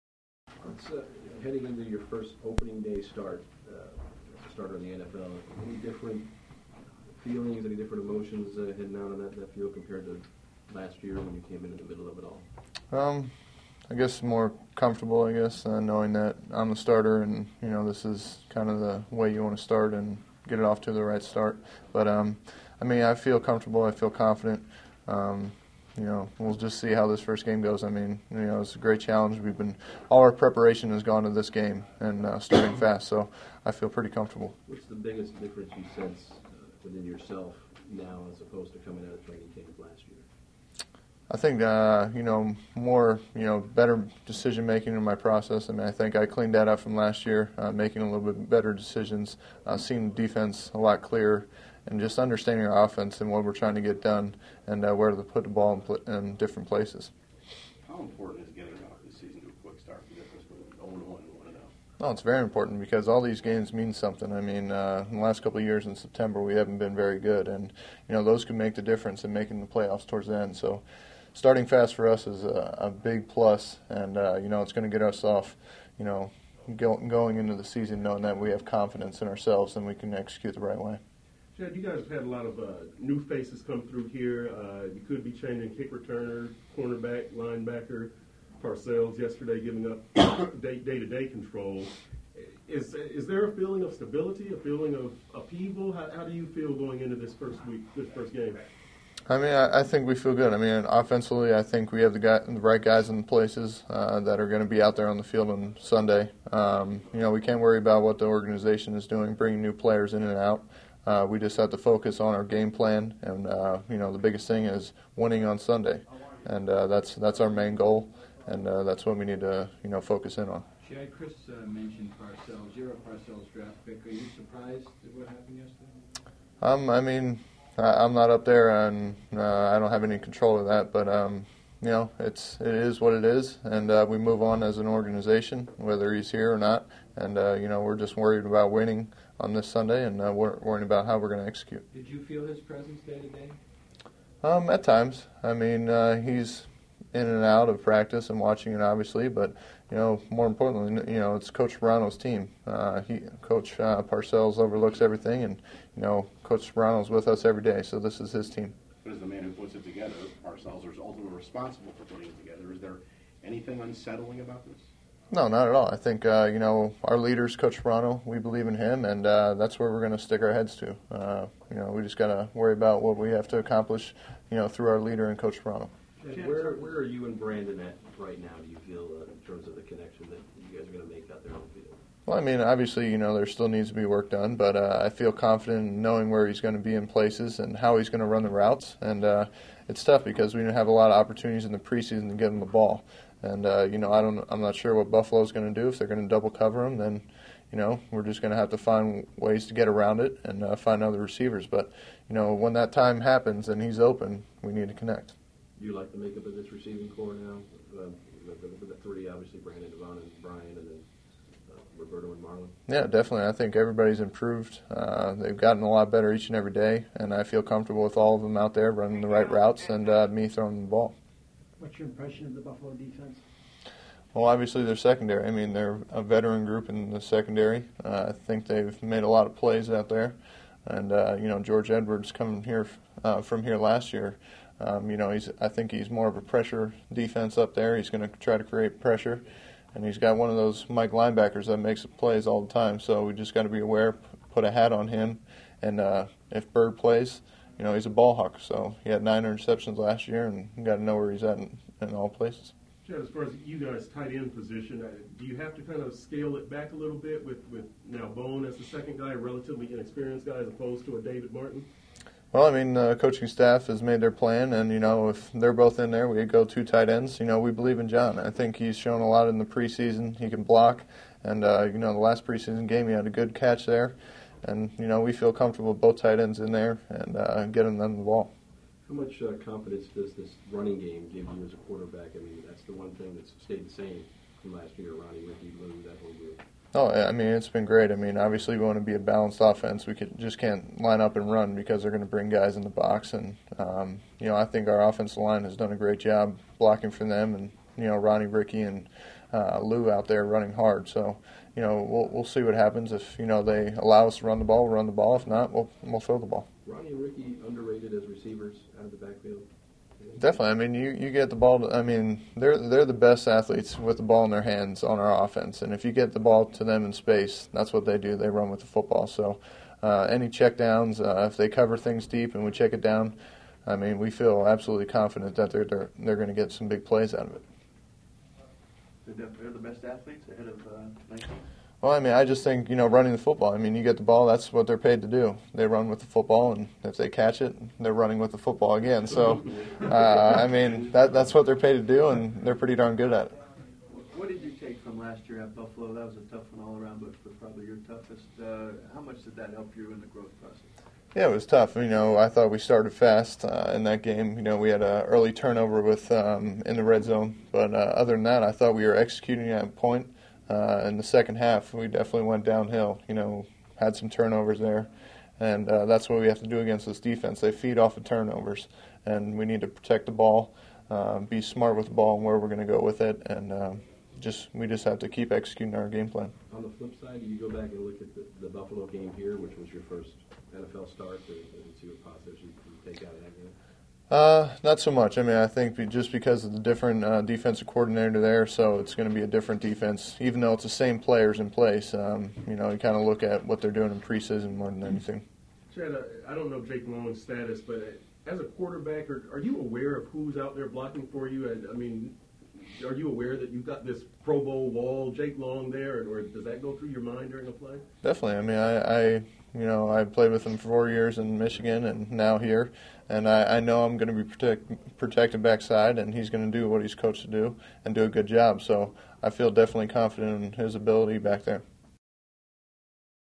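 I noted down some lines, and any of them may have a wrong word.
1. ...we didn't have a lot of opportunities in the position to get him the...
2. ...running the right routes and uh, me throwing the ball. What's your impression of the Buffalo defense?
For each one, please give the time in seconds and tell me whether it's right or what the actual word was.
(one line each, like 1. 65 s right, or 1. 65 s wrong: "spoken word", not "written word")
1. 190 s wrong: "preseason", not "position"
2. 218 s right.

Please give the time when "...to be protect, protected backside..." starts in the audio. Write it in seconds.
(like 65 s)
414 s.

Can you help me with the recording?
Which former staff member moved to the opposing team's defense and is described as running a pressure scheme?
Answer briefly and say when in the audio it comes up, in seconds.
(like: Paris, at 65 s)
George Edwards, at 231 s.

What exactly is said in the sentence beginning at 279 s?
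How much uh, confidence does this running game give you as a quarterback?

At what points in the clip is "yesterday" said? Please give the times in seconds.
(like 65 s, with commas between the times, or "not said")
89 s, 125 s.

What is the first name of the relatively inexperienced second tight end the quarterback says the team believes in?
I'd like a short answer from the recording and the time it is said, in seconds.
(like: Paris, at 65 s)
John, at 268 s.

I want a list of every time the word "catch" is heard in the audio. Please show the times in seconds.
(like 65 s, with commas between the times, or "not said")
273 s, 337 s.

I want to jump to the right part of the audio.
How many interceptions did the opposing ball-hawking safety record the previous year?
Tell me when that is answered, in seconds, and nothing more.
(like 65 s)
249 s.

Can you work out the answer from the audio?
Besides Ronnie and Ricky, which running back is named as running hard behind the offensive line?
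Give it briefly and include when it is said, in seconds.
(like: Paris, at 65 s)
Lou, at 299 s.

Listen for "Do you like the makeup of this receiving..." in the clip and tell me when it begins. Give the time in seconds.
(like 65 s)
205 s.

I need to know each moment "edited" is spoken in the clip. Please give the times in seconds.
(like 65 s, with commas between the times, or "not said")
not said.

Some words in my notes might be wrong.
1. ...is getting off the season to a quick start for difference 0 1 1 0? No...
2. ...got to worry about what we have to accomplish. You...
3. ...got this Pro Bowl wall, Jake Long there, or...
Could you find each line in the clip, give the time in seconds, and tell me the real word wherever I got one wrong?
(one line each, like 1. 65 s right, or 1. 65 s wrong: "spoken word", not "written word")
1. 58 s right
2. 172 s right
3. 403 s right.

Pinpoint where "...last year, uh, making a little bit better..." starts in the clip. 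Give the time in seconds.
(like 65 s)
46 s.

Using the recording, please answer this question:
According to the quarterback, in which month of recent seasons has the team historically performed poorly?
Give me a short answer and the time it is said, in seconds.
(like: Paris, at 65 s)
September, at 65 s.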